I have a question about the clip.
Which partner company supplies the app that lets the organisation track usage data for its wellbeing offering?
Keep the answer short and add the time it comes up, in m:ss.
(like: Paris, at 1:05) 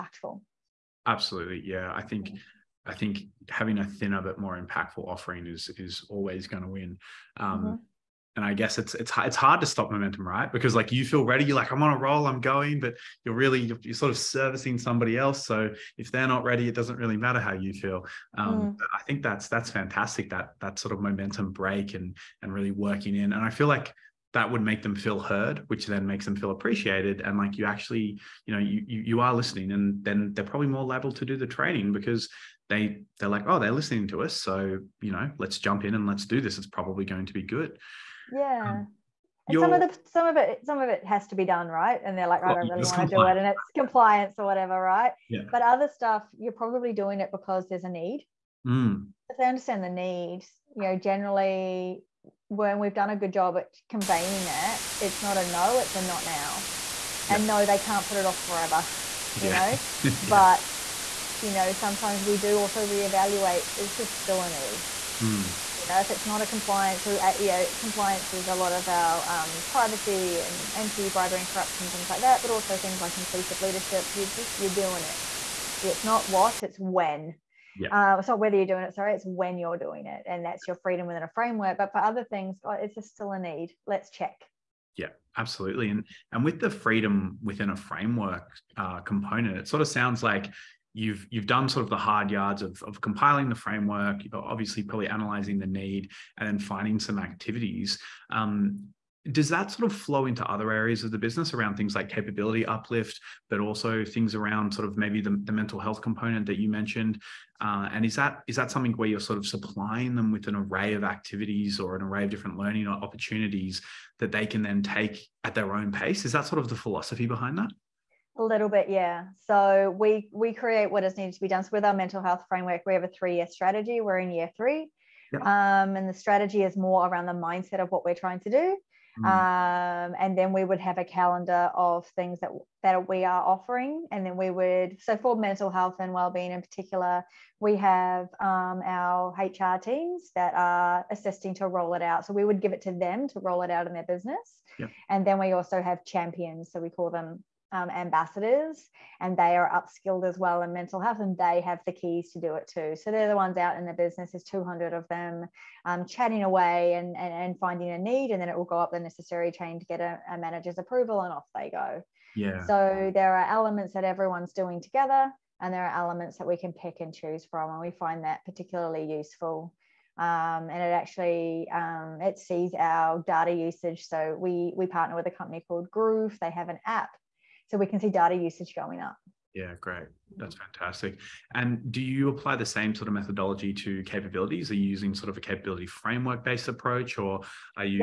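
Groov, at 2:55.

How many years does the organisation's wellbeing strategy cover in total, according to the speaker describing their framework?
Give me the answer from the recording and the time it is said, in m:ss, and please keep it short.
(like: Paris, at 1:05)
3, at 2:03.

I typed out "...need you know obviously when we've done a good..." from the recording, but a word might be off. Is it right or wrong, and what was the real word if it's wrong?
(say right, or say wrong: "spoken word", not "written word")
wrong: "generally", not "obviously".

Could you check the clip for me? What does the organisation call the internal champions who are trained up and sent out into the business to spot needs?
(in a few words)
ambassadors.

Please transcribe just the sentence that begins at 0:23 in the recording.
And I feel like that would make them feel heard, which then makes them feel appreciated.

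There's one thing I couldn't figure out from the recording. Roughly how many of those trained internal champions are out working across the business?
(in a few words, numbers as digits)
200.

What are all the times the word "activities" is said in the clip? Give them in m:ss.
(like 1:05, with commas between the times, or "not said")
1:37, 1:51.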